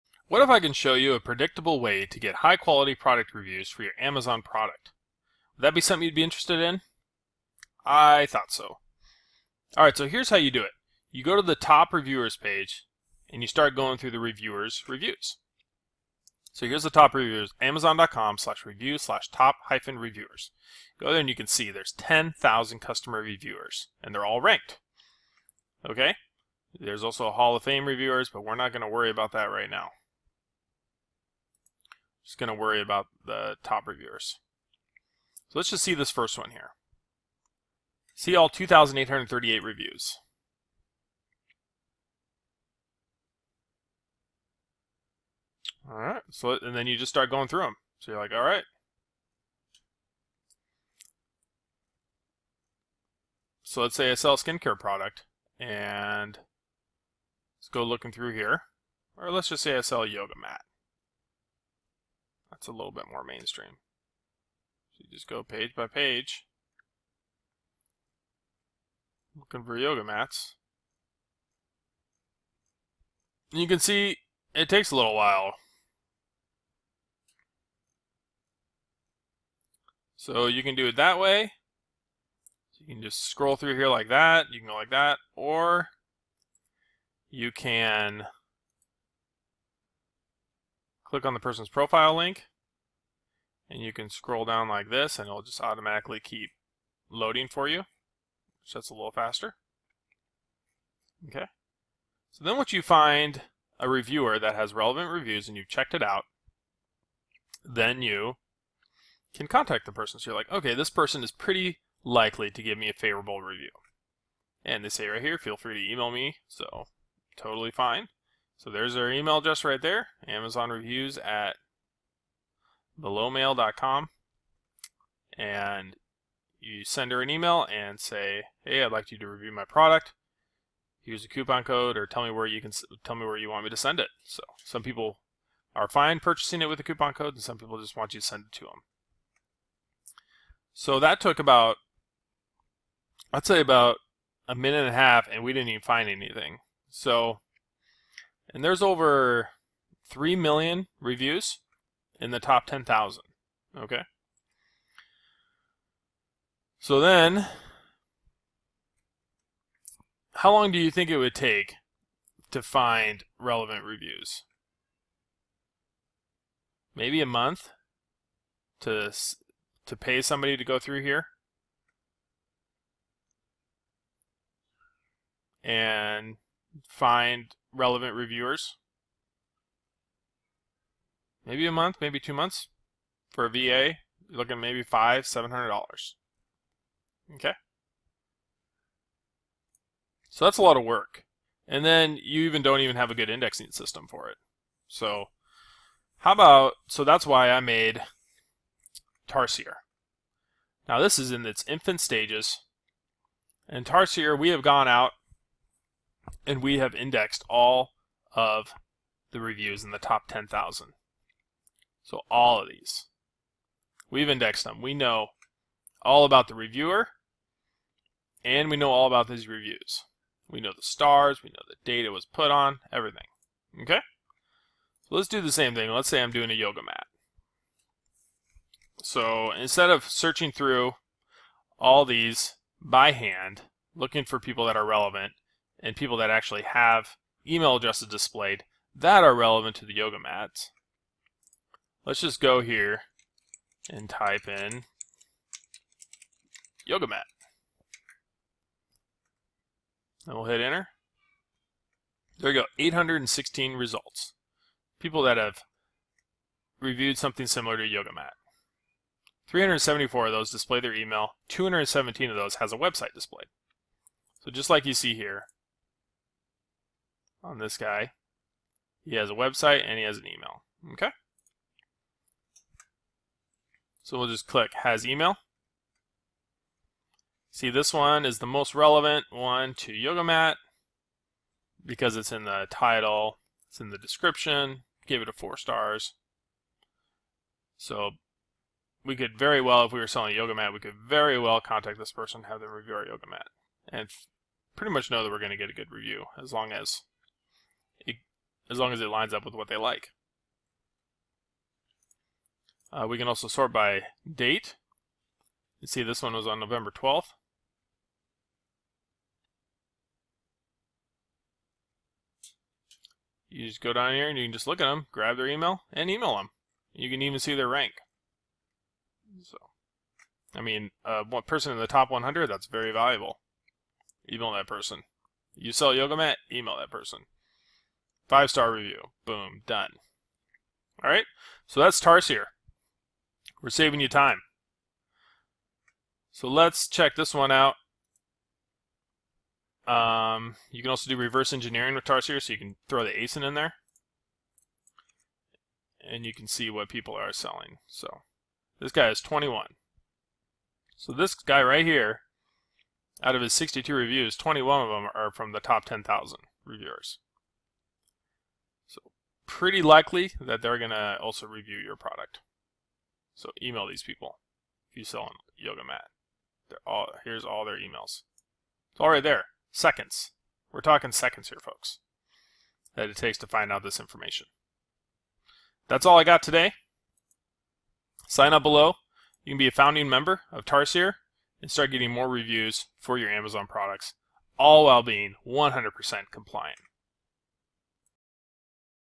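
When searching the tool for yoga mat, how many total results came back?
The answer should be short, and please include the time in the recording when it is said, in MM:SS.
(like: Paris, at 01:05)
816, at 04:12.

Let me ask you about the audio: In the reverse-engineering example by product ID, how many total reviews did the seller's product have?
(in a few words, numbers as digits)
62.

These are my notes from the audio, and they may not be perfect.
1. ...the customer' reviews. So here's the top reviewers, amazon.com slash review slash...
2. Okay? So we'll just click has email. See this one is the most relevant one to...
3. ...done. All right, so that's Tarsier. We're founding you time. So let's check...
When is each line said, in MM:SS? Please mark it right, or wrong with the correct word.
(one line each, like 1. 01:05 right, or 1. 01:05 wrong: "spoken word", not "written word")
1. 00:14 wrong: "reviewers", not "customer"
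2. 04:30 right
3. 05:29 wrong: "saving", not "founding".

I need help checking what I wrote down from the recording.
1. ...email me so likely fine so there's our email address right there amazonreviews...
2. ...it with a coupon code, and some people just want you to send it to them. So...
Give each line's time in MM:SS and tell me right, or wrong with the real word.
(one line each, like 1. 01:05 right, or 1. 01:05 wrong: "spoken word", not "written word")
1. 01:55 wrong: "totally", not "likely"
2. 02:16 right.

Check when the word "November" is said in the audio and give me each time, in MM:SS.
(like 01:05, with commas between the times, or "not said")
05:06.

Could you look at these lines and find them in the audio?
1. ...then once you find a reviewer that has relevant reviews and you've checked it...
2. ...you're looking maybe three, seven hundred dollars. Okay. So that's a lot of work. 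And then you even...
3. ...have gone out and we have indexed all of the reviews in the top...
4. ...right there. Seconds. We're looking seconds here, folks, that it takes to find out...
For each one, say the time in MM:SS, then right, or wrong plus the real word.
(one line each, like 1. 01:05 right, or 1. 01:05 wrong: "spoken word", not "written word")
1. 01:42 right
2. 03:04 wrong: "five", not "three"
3. 03:24 right
4. 06:09 wrong: "talking", not "looking".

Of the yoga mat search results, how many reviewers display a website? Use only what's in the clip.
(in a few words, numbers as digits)
217.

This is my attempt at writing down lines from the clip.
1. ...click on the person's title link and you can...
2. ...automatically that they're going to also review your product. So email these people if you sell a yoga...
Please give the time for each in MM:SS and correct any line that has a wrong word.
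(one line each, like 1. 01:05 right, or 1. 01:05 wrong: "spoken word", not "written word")
1. 01:31 wrong: "profile", not "title"
2. 05:59 wrong: "likely", not "automatically".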